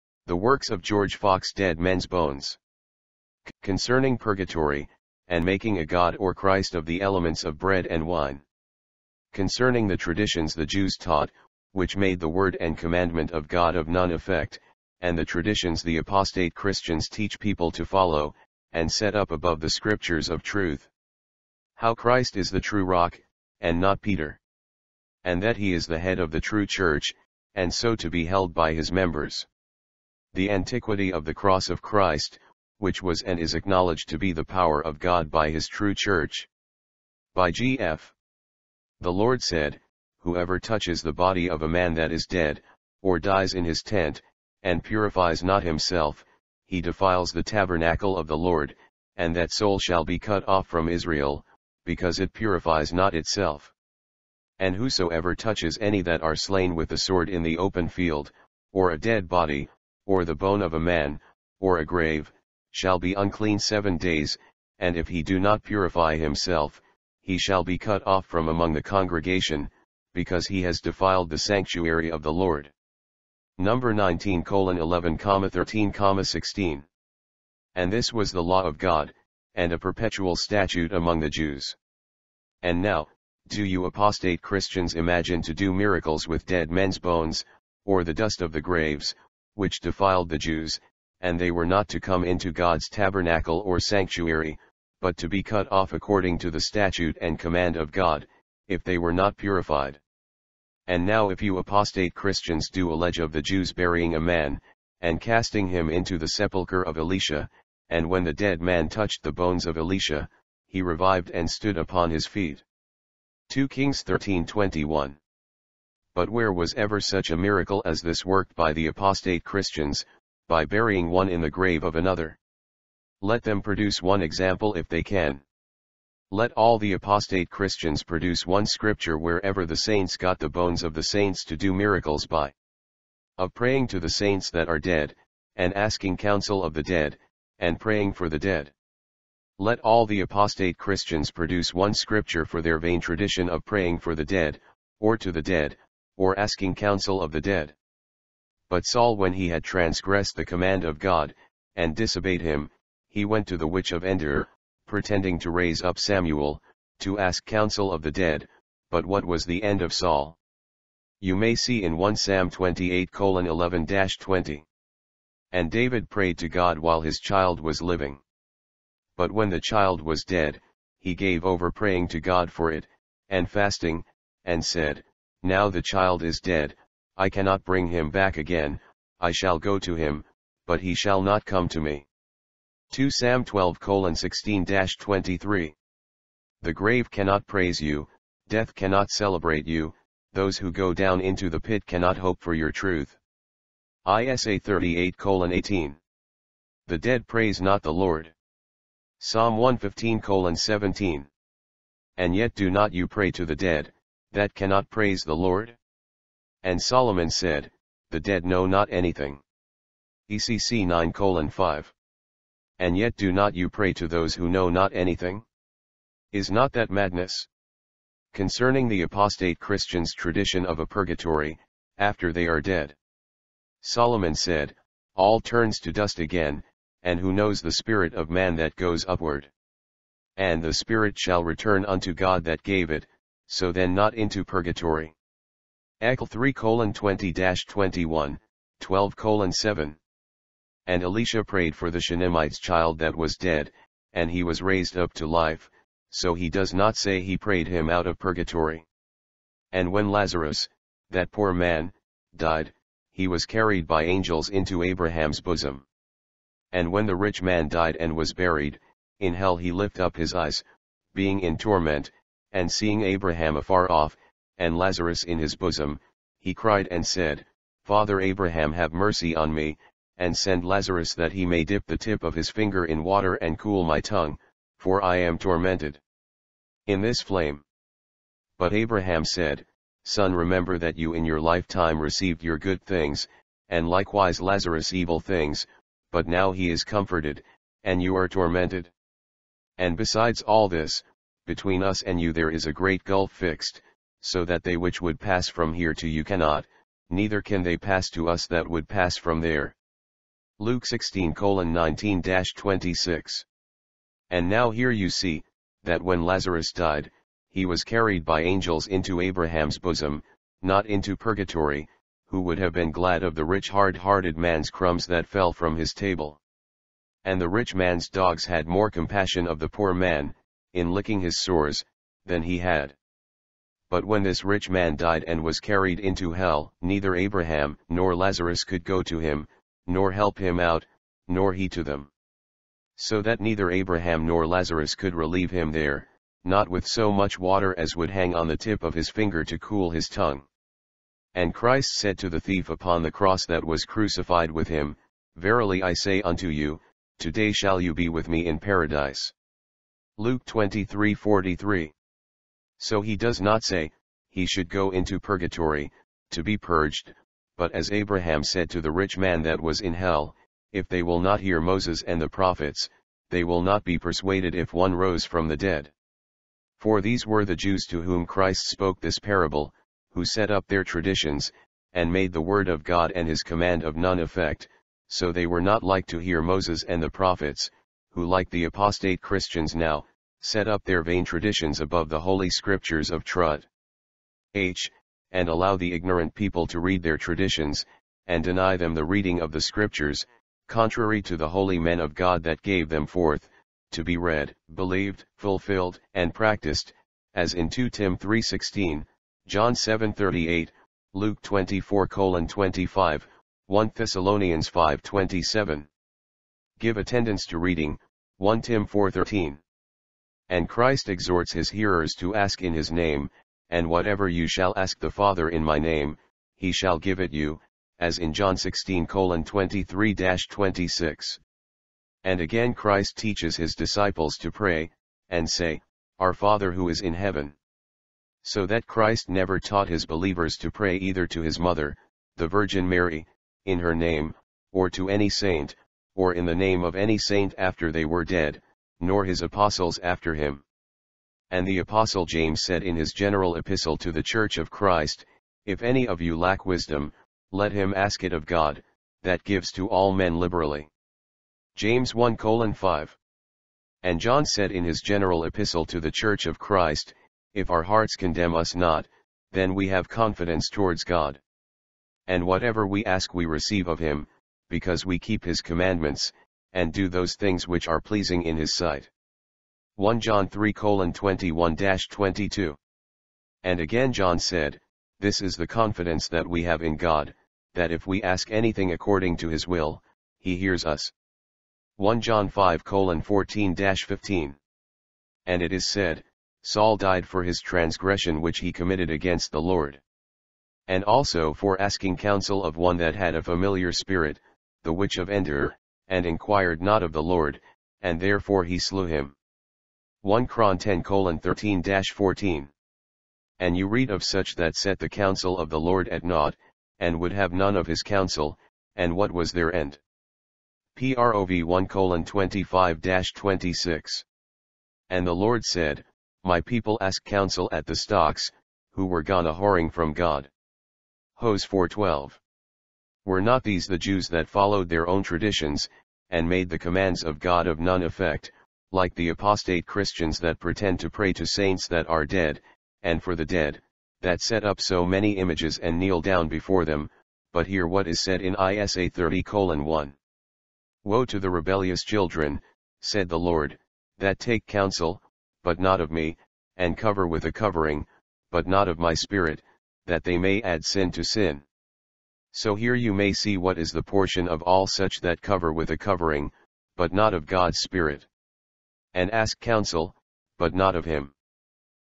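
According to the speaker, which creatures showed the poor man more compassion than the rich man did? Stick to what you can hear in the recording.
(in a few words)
the rich man's dogs.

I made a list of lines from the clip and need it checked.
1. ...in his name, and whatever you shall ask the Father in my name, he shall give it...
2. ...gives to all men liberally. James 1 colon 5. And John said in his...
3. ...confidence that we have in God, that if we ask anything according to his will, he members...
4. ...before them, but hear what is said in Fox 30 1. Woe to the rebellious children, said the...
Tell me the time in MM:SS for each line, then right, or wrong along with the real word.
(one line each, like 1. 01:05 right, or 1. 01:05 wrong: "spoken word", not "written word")
1. 06:52 right
2. 07:29 right
3. 07:55 wrong: "hears", not "members"
4. 08:56 wrong: "Isa", not "Fox".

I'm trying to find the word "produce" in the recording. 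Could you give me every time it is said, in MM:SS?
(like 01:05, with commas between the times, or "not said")
02:03, 02:08, 02:21.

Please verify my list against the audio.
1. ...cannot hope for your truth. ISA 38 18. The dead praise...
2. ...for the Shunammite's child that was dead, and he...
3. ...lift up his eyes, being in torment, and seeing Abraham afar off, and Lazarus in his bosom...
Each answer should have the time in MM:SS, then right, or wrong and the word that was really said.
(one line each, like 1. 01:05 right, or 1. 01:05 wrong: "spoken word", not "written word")
1. 03:11 right
2. 04:01 right
3. 04:19 right.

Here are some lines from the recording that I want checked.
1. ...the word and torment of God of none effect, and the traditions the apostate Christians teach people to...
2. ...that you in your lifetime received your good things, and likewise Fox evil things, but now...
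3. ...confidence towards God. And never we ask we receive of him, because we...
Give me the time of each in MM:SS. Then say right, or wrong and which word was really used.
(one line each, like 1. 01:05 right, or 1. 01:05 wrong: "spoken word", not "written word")
1. 00:12 wrong: "commandment", not "torment"
2. 04:40 wrong: "Lazarus", not "Fox"
3. 07:40 wrong: "whatever", not "never".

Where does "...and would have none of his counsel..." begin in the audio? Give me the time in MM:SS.
08:26.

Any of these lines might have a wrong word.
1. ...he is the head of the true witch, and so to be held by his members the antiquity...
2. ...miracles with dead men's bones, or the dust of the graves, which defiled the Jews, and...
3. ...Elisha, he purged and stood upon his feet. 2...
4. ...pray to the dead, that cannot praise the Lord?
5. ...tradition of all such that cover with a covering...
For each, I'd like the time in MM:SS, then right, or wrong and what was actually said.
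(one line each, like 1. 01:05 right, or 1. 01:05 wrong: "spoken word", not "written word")
1. 00:25 wrong: "church", not "witch"
2. 01:25 right
3. 01:49 wrong: "revived", not "purged"
4. 03:23 right
5. 09:14 wrong: "portion", not "tradition".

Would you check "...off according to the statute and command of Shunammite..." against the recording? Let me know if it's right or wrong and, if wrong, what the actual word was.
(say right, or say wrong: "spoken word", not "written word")
wrong: "God", not "Shunammite".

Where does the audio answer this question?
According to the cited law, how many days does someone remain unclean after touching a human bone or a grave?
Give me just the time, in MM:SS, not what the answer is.
01:03.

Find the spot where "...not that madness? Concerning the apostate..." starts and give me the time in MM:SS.
03:36.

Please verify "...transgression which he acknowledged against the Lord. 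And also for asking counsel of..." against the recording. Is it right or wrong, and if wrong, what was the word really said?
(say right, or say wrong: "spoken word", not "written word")
wrong: "committed", not "acknowledged".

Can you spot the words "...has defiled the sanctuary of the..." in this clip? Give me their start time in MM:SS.
01:10.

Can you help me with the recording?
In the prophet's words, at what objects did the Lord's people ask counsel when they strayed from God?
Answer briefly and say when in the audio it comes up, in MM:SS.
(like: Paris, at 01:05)
the stocks, at 08:37.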